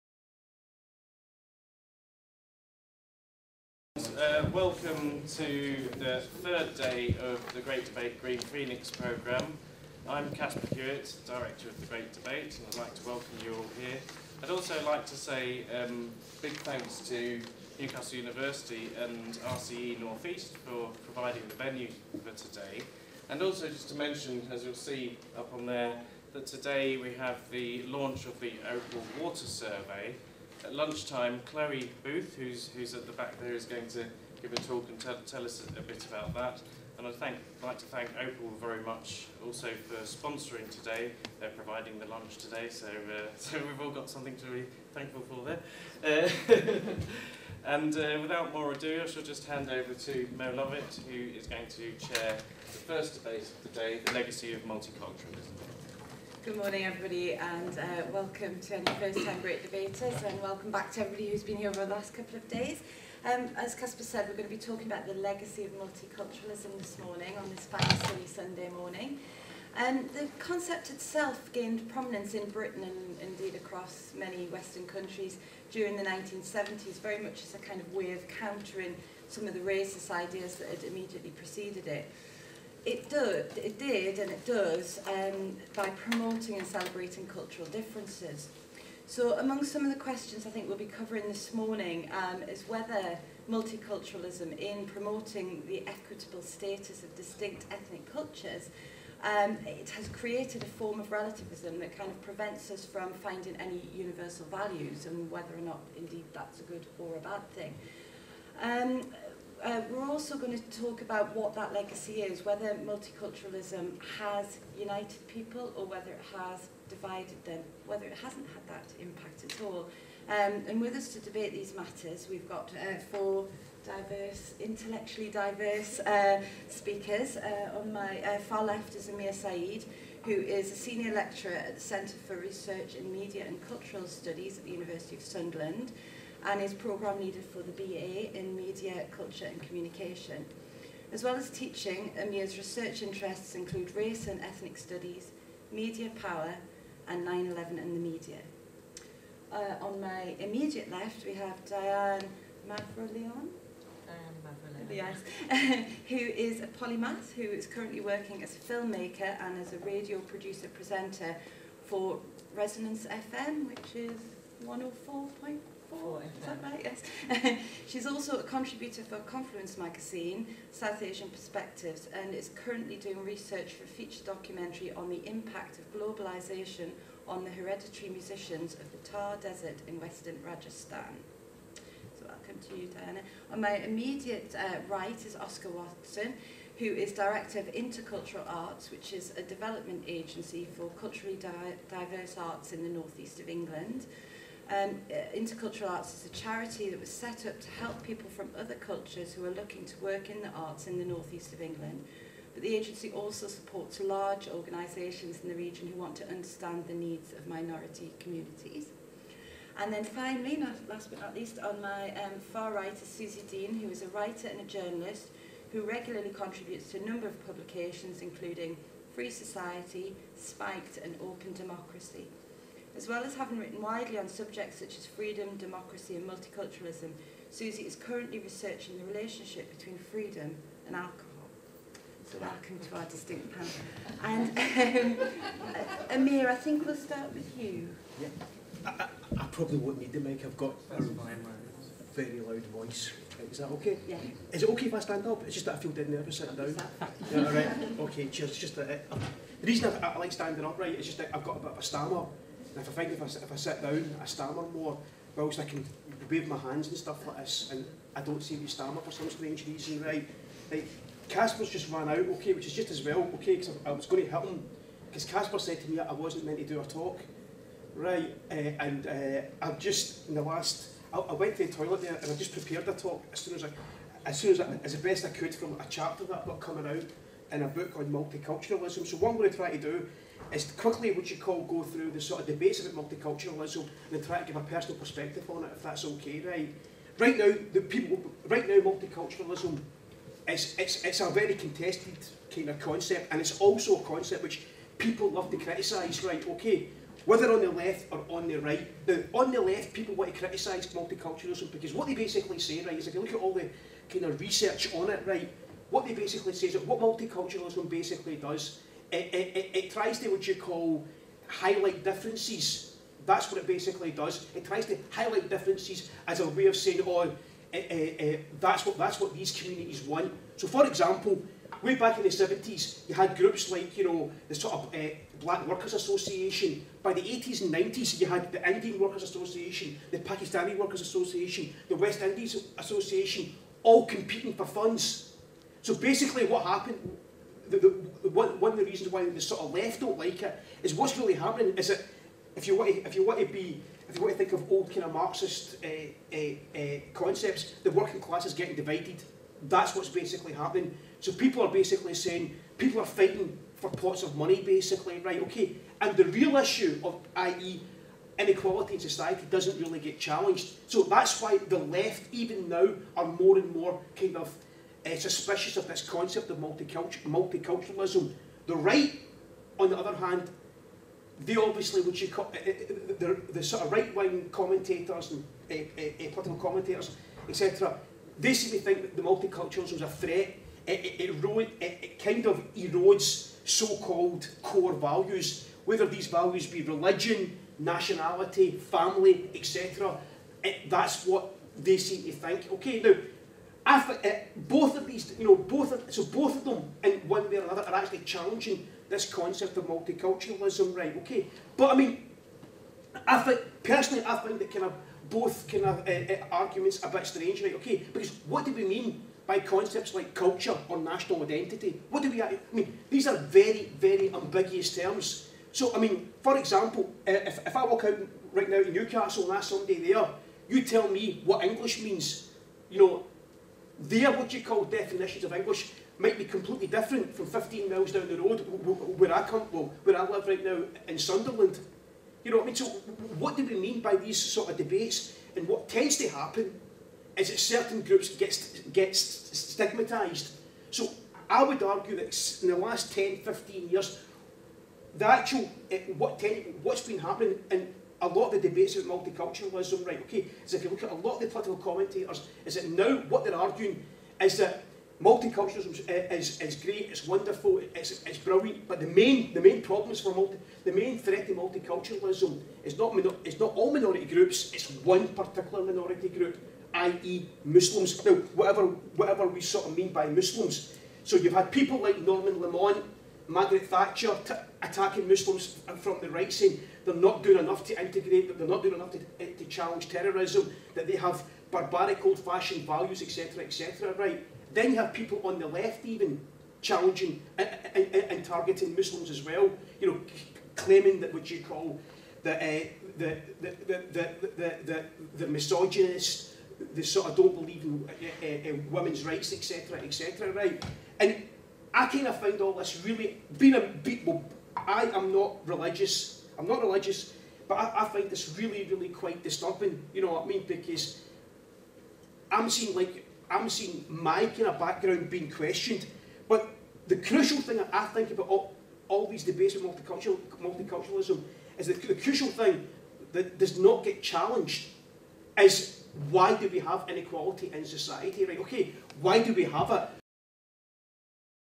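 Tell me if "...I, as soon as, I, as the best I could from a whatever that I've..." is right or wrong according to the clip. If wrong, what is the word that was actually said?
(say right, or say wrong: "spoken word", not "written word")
wrong: "chapter", not "whatever".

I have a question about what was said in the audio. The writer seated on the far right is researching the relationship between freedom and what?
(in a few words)
alcohol.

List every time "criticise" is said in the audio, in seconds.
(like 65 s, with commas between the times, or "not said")
295 s, 300 s.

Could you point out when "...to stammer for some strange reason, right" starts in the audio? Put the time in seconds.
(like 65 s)
258 s.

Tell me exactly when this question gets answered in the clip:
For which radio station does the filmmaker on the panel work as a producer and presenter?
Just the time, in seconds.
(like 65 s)
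162 s.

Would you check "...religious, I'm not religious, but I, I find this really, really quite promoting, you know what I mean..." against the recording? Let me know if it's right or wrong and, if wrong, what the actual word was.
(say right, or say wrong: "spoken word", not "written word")
wrong: "disturbing", not "promoting".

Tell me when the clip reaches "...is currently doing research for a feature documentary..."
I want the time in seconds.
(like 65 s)
172 s.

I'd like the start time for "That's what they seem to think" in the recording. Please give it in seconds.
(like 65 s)
390 s.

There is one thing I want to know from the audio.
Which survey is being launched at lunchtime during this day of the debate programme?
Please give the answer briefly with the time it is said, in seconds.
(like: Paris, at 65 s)
Opal Water Survey, at 28 s.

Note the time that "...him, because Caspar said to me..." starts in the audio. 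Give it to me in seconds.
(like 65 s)
264 s.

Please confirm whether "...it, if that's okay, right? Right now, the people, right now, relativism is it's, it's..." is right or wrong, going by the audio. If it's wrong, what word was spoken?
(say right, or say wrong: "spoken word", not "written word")
wrong: "multiculturalism", not "relativism".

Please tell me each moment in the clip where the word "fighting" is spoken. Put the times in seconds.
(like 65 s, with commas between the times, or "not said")
353 s.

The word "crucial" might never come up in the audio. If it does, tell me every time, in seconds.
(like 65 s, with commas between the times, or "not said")
517 s, 522 s.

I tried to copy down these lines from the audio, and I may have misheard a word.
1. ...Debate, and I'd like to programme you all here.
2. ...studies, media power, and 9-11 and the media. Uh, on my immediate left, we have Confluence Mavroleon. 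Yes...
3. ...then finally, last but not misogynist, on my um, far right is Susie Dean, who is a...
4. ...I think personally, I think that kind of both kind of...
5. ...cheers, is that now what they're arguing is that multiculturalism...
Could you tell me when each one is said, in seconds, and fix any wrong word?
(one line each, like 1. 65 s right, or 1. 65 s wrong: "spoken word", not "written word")
1. 12 s wrong: "welcome", not "programme"
2. 144 s wrong: "Diane", not "Confluence"
3. 209 s wrong: "least", not "misogynist"
4. 403 s right
5. 451 s wrong: "commentators", not "cheers".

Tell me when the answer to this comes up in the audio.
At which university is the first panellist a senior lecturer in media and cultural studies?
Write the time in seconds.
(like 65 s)
134 s.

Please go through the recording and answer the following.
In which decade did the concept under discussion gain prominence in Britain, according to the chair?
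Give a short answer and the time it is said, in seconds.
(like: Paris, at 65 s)
1970s, at 76 s.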